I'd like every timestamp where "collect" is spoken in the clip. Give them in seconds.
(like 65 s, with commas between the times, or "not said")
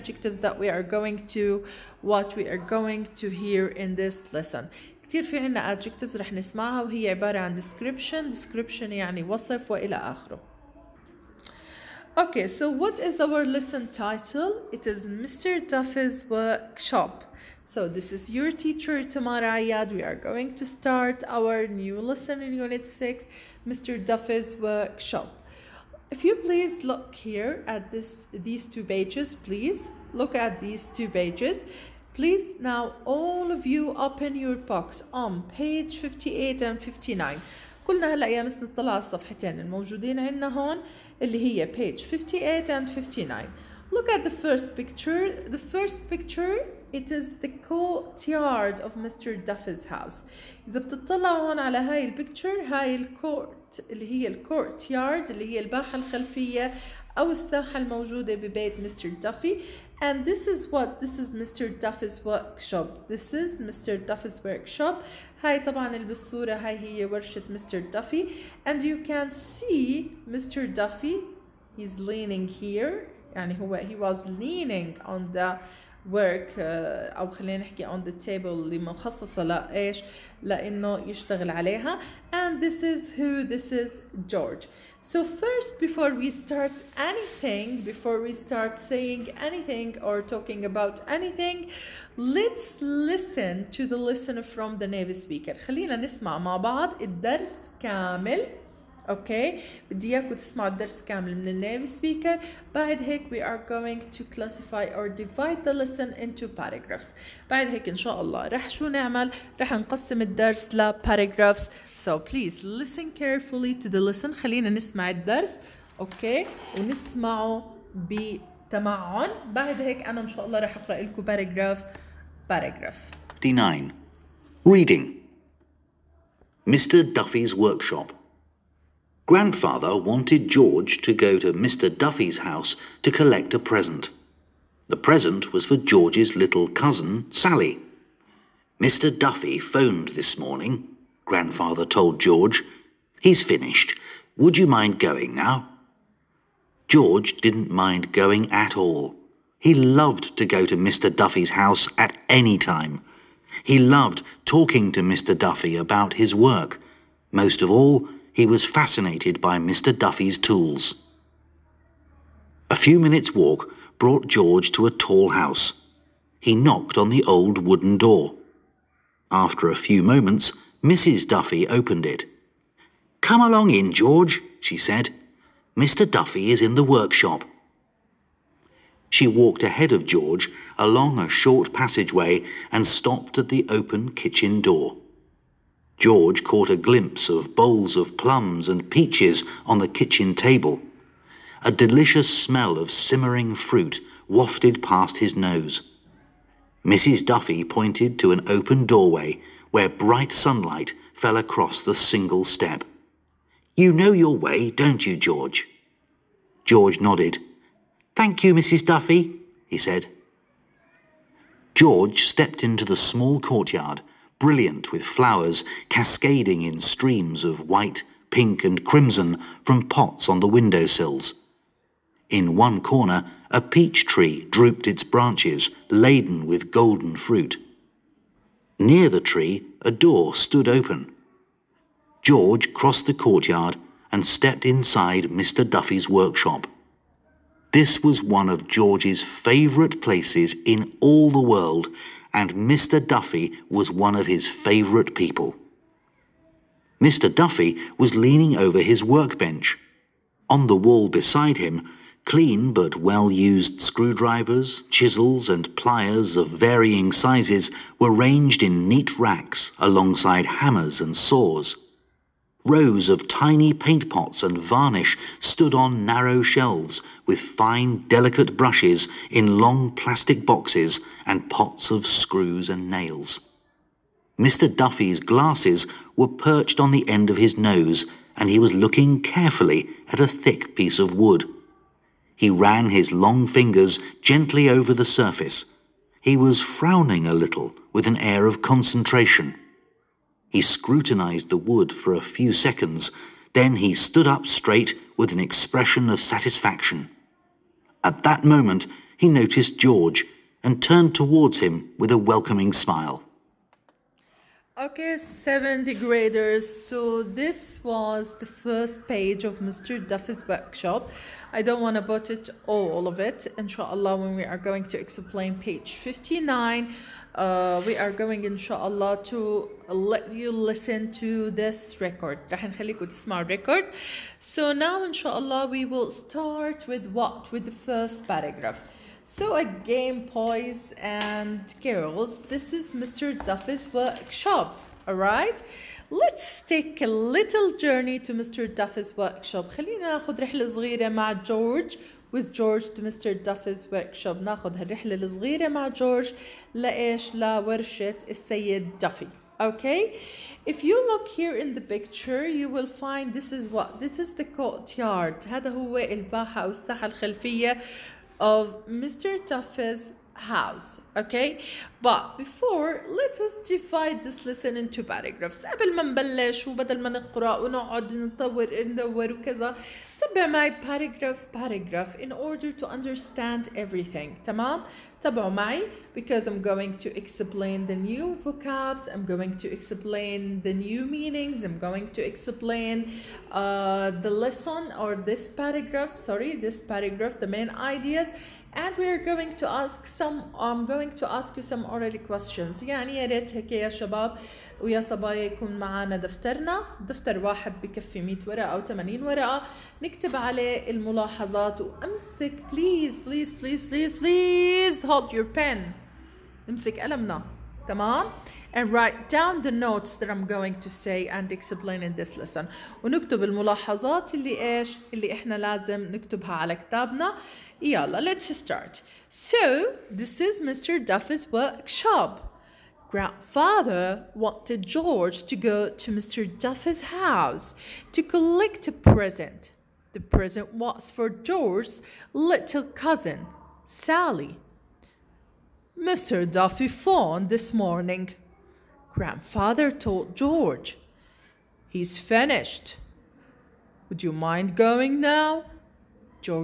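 133 s, 428 s.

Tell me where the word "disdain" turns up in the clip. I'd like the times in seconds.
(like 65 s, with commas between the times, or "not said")
not said.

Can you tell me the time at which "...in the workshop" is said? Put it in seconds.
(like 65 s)
176 s.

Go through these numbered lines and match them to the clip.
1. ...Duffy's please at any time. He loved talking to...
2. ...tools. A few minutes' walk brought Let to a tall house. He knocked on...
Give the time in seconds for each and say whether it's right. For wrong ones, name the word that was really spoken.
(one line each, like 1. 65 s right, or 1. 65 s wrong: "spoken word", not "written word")
1. 151 s wrong: "house", not "please"
2. 160 s wrong: "George", not "Let".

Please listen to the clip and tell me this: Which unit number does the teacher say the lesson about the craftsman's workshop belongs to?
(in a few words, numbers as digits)
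6.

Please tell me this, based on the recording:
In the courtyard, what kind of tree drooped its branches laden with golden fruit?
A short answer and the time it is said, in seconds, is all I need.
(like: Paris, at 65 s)
Peach tree, at 223 s.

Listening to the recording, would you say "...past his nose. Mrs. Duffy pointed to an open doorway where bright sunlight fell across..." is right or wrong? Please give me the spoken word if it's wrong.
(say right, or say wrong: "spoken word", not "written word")
right.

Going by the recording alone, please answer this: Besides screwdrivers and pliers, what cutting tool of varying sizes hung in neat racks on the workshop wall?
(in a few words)
Chisels.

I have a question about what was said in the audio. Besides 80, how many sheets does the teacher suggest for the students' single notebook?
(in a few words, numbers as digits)
100.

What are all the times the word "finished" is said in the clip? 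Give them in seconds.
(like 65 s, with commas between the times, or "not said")
143 s, 442 s.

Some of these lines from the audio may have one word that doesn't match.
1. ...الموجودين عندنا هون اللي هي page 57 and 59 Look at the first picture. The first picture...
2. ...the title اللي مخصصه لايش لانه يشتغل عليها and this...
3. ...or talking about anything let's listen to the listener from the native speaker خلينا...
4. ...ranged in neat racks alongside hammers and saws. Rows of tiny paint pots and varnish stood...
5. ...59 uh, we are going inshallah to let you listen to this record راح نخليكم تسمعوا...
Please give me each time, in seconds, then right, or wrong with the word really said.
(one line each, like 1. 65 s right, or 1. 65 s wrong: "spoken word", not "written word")
1. 39 s wrong: "58", not "57"
2. 78 s wrong: "table", not "title"
3. 90 s right
4. 258 s right
5. 315 s right.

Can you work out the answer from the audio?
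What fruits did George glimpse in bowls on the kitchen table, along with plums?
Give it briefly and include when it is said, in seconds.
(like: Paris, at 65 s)
Peaches, at 188 s.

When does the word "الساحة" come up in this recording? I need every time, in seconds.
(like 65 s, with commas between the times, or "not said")
57 s, 356 s.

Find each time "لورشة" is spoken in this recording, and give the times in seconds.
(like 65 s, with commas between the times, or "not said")
347 s.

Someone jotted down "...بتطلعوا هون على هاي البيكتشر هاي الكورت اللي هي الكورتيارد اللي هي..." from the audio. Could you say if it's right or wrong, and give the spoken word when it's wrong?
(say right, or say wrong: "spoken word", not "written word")
right.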